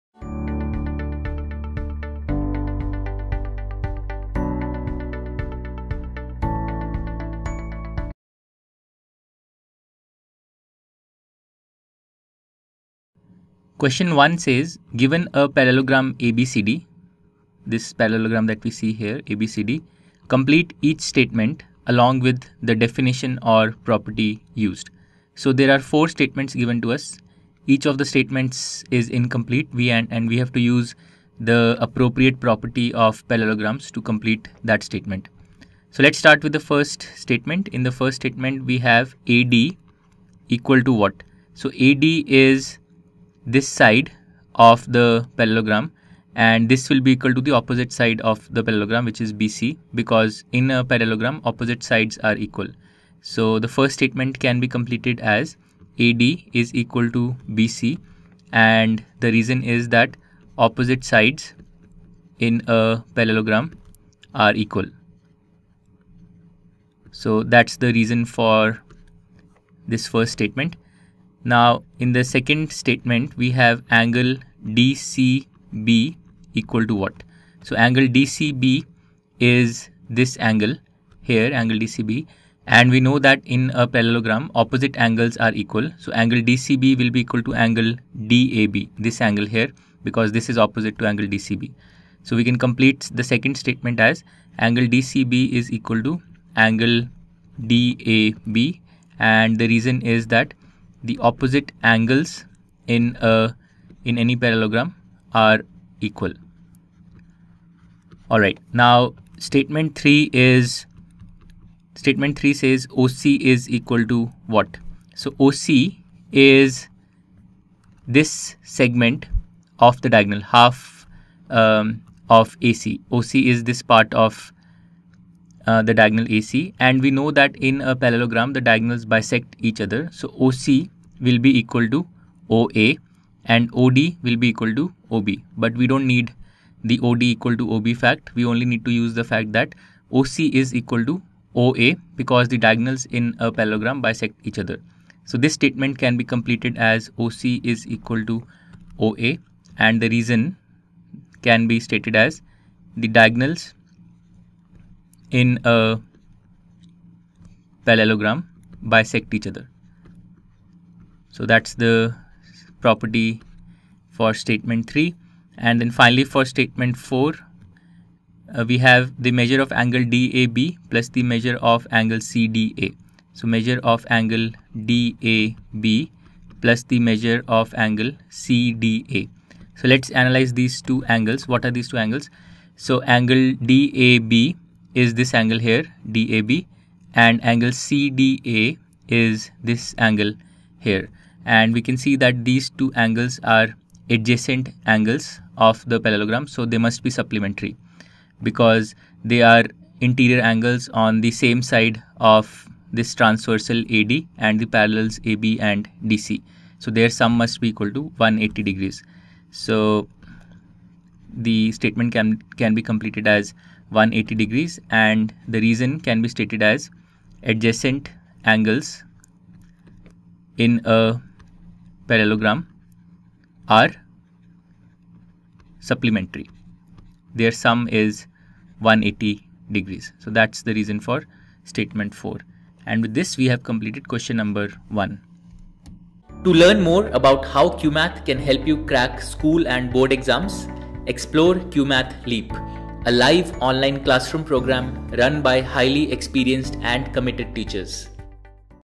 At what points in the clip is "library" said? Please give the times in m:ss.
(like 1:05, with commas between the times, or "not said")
not said.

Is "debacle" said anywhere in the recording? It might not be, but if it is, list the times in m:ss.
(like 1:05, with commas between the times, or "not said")
not said.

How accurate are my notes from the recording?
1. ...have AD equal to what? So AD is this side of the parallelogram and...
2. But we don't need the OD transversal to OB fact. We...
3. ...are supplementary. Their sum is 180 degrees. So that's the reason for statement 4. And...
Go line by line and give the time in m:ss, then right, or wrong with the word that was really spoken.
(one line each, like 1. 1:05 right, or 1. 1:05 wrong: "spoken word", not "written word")
1. 0:38 right
2. 2:15 wrong: "equal", not "transversal"
3. 3:43 right.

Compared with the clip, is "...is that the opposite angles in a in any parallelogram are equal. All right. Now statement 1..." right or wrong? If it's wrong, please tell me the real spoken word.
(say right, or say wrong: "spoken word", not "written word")
wrong: "3", not "1".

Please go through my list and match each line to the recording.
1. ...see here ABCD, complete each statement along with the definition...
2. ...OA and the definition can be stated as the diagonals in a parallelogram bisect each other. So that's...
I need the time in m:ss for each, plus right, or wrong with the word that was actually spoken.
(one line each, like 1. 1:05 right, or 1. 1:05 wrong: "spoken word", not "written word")
1. 0:18 right
2. 2:28 wrong: "reason", not "definition".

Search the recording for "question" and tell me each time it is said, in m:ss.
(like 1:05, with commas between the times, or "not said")
0:13, 3:54.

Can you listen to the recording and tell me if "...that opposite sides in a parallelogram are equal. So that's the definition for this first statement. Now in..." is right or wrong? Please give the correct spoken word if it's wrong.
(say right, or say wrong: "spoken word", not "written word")
wrong: "reason", not "definition".